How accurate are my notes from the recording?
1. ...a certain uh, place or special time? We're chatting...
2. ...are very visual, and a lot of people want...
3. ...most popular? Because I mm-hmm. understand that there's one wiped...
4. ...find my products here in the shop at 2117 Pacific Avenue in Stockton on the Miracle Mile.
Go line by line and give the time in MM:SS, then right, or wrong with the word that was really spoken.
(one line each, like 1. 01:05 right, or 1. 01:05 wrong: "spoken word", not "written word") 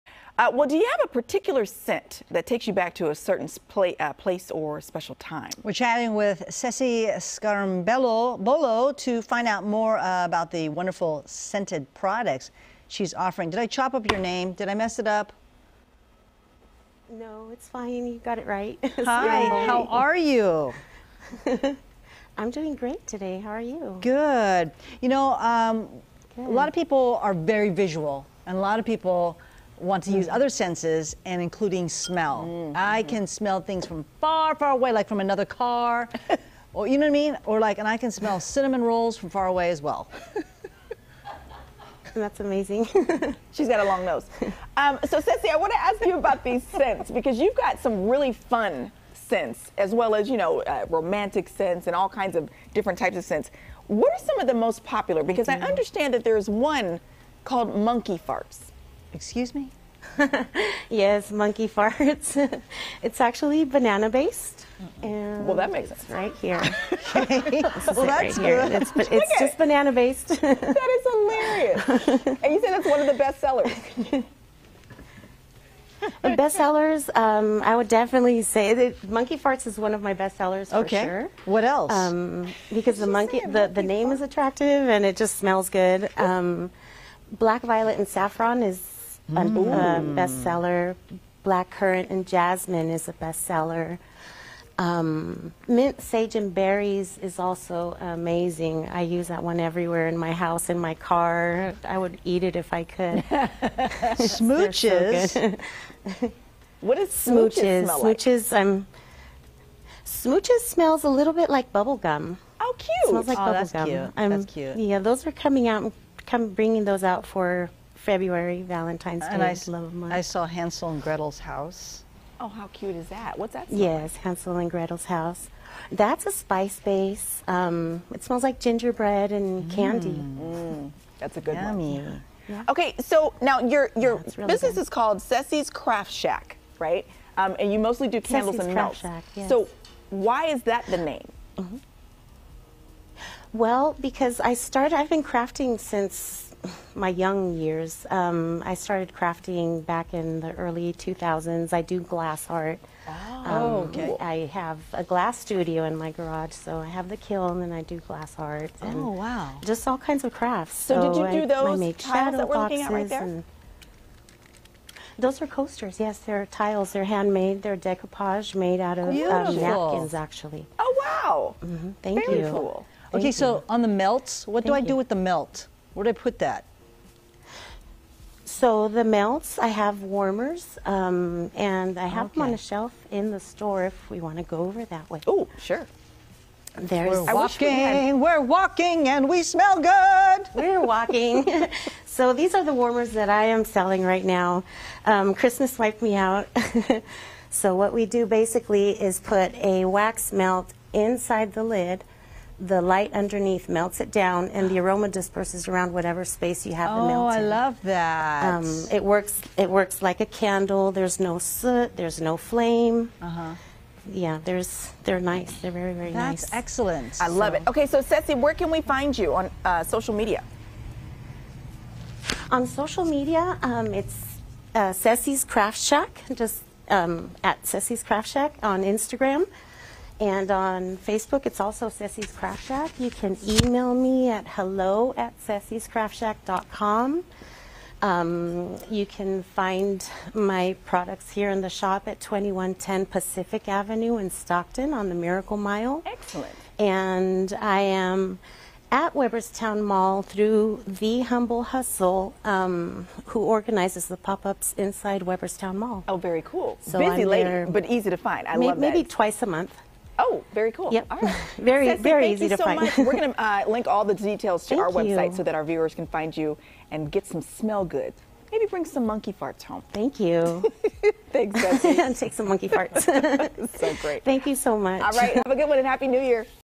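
1. 00:03 right
2. 00:27 right
3. 00:54 wrong: "called", not "wiped"
4. 03:59 wrong: "2110", not "2117".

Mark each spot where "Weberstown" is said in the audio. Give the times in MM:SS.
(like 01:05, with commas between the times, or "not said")
04:09, 04:15.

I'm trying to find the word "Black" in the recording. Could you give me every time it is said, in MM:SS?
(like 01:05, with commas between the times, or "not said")
01:27, 01:31.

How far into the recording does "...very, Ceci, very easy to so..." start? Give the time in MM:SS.
04:21.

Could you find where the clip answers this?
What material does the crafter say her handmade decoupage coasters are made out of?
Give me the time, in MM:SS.
02:49.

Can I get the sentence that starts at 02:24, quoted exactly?
I've been crafting since my young years.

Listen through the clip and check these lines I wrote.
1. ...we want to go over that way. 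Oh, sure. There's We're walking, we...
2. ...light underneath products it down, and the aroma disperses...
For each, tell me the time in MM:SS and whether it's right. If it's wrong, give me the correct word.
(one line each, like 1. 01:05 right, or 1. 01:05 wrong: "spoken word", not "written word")
1. 03:04 right
2. 03:22 wrong: "melts", not "products".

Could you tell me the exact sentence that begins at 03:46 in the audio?
Just um, at Ceci's Craft Shack on Instagram.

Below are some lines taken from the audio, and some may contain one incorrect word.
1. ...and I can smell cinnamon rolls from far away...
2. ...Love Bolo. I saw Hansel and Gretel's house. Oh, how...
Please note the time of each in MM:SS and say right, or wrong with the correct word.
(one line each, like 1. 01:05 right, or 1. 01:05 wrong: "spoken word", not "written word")
1. 00:37 right
2. 01:59 wrong: "Month", not "Bolo".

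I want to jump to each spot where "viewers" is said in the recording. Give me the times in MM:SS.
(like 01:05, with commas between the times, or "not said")
04:25.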